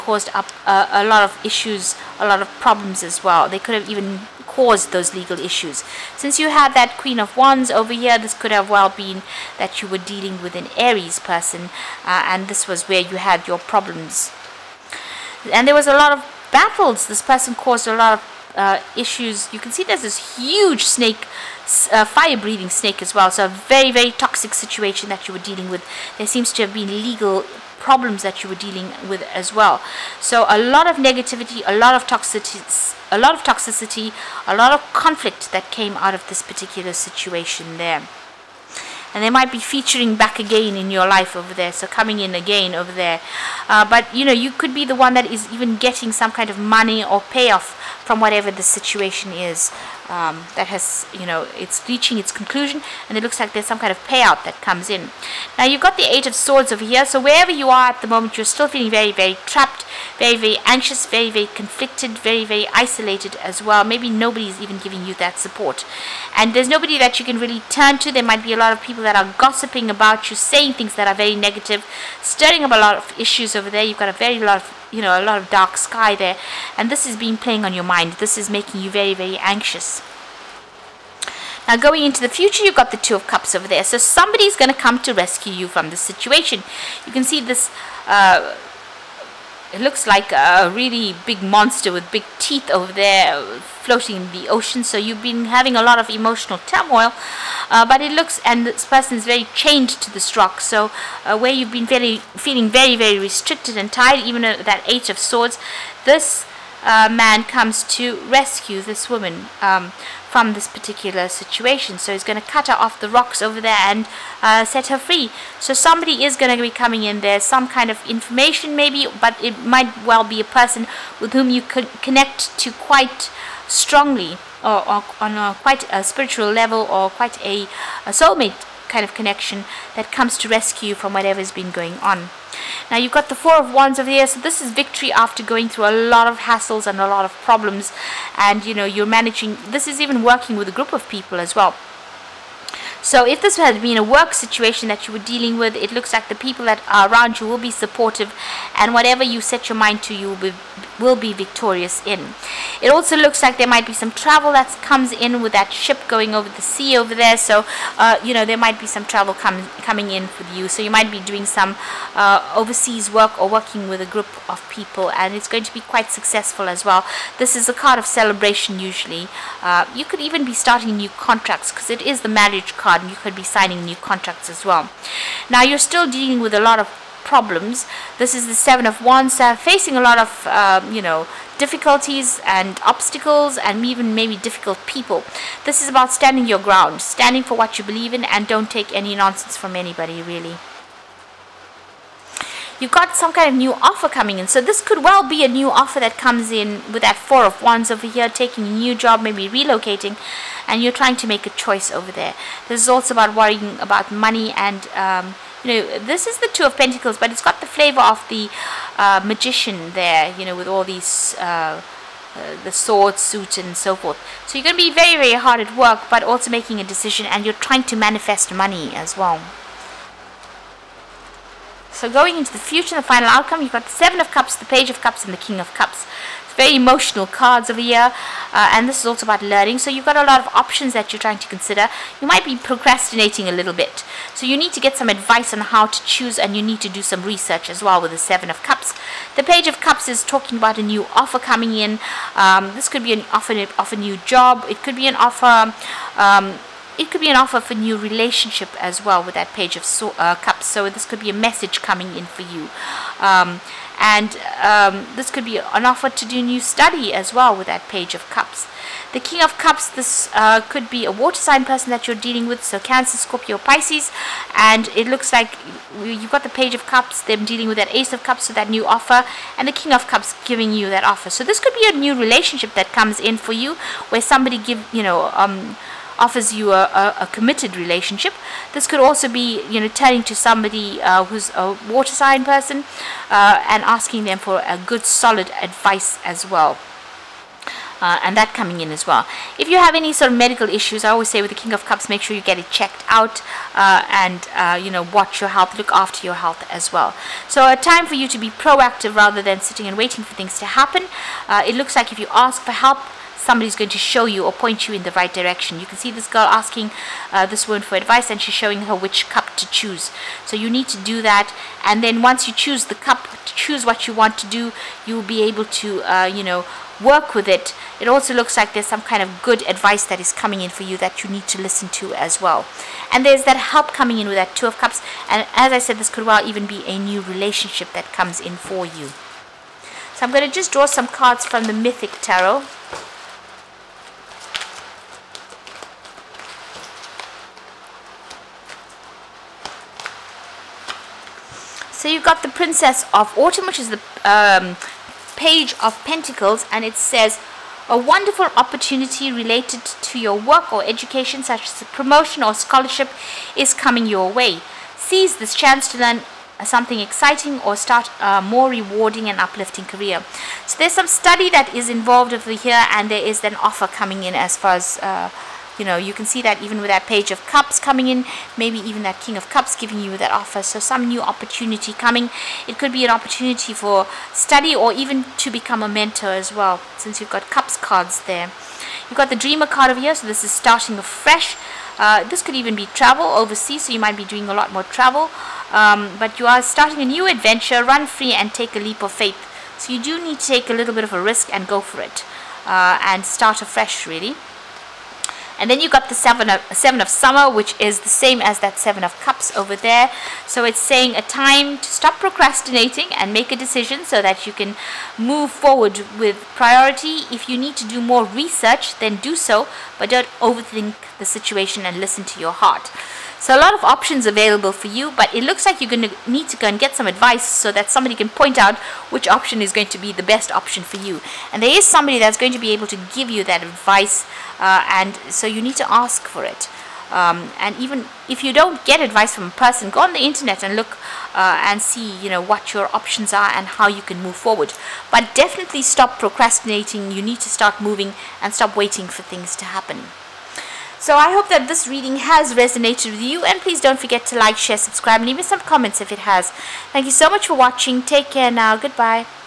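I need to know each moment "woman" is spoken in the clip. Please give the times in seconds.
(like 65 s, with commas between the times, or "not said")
109 s, 307 s.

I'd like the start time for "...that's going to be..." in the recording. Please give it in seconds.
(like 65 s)
422 s.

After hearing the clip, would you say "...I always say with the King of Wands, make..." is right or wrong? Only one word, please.
wrong.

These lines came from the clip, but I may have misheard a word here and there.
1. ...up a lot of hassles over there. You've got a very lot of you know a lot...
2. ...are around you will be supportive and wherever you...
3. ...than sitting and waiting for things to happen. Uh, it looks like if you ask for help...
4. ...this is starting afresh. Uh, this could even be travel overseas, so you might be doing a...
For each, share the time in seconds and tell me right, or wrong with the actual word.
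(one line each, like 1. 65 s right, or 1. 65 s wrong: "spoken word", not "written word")
1. 72 s wrong: "issues", not "hassles"
2. 146 s wrong: "whatever", not "wherever"
3. 299 s right
4. 380 s right.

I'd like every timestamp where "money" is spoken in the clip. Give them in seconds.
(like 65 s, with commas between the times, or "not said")
46 s, 204 s, 218 s.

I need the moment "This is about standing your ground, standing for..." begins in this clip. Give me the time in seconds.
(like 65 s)
185 s.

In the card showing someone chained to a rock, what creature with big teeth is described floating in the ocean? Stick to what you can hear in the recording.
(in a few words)
monster.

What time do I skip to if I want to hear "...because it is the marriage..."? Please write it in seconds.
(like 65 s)
171 s.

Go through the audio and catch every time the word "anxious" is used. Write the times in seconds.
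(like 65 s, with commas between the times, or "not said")
60 s, 79 s.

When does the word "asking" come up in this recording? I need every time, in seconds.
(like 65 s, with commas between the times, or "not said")
283 s, 306 s.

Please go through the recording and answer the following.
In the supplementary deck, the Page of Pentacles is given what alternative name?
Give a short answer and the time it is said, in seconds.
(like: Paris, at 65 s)
Princess of Autumn, at 342 s.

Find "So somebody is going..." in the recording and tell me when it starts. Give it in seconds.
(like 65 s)
115 s.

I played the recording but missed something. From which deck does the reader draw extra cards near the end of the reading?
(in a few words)
Mythic Tarot.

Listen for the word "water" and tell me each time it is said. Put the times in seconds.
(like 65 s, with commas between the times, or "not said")
261 s, 281 s.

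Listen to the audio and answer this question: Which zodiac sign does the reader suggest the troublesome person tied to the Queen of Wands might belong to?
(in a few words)
Aries.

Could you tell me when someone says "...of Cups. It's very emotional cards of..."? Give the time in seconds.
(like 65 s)
225 s.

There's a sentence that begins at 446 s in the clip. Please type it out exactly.
Thank you so much for watching.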